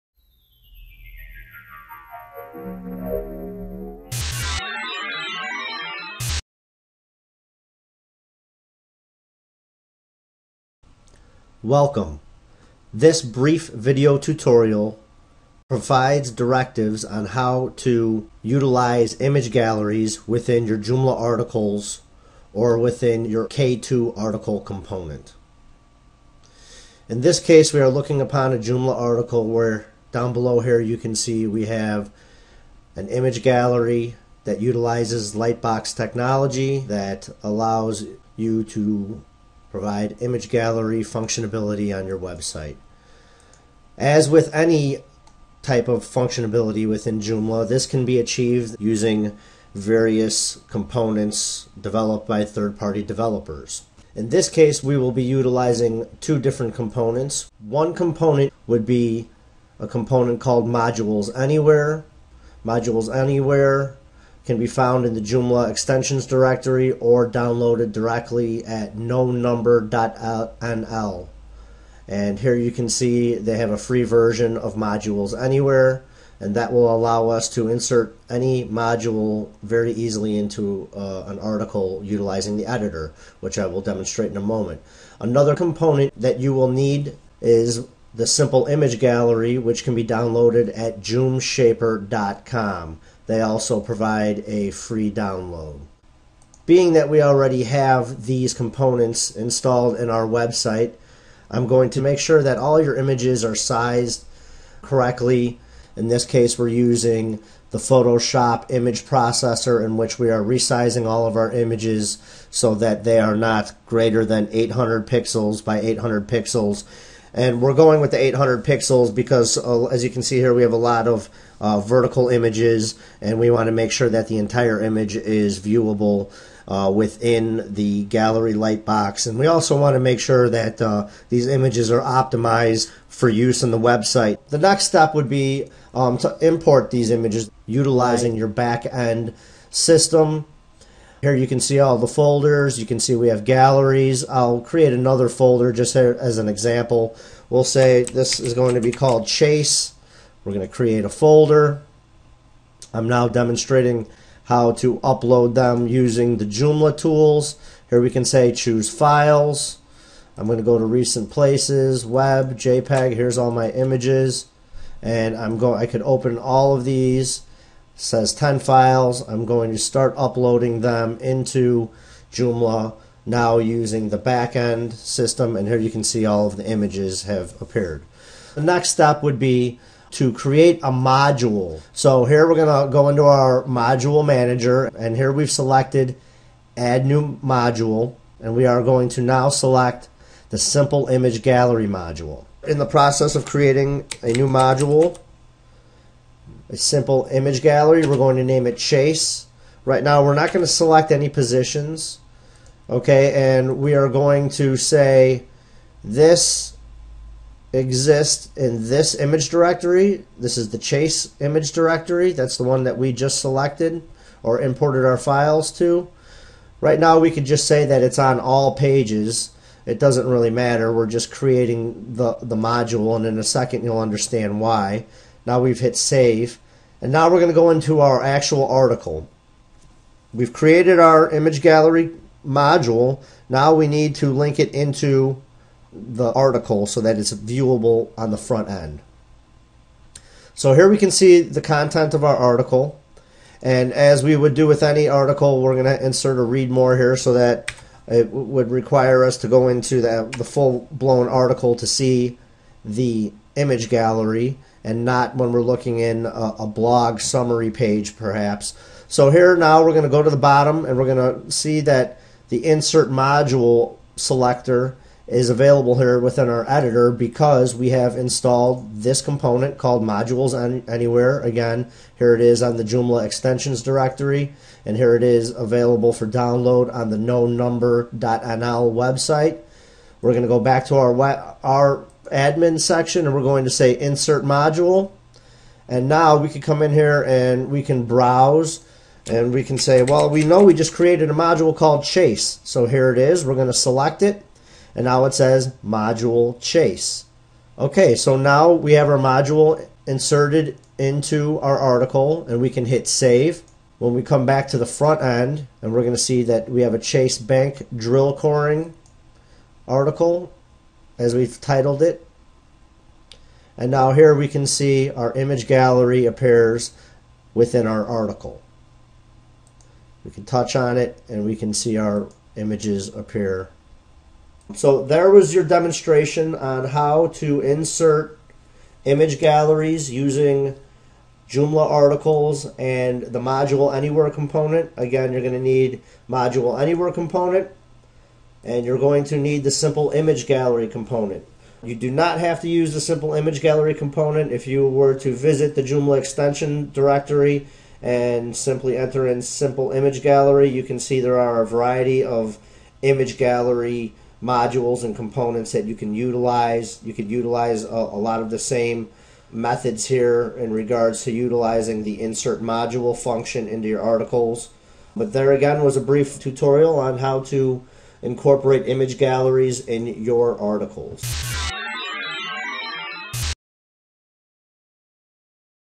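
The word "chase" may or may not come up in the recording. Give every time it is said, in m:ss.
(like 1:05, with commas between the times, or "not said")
2:29, 3:18, 3:30, 4:52, 4:56, 5:06.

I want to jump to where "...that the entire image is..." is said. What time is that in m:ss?
2:04.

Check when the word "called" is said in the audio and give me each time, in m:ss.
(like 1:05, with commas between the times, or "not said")
1:00, 2:28, 4:29, 4:51.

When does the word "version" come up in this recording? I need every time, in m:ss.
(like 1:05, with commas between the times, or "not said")
1:14.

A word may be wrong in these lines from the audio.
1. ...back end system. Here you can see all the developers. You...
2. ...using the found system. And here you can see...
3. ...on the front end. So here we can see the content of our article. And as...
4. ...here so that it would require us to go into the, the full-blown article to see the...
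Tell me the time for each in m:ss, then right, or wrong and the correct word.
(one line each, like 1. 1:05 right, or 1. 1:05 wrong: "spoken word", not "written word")
1. 2:18 wrong: "folders", not "developers"
2. 2:53 wrong: "backend", not "found"
3. 3:58 right
4. 4:06 right.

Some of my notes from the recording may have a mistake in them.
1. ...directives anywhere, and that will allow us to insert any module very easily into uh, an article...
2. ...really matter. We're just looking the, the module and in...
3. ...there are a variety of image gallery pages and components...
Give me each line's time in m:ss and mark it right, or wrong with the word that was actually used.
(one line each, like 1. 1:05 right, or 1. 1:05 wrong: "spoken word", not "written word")
1. 1:14 wrong: "modules", not "directives"
2. 3:40 wrong: "creating", not "looking"
3. 5:51 wrong: "modules", not "pages".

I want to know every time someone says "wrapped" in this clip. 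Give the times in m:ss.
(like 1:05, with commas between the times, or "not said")
not said.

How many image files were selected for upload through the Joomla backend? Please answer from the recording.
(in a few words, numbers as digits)
10.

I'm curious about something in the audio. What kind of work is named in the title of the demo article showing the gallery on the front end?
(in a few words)
drill coring.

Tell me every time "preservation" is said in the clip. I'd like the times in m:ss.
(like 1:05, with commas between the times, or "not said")
not said.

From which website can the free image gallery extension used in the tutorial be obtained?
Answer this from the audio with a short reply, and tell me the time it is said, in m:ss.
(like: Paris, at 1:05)
joomshaper.com, at 1:31.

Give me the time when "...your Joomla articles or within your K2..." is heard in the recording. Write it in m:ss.
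0:20.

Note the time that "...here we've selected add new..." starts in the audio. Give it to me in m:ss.
3:05.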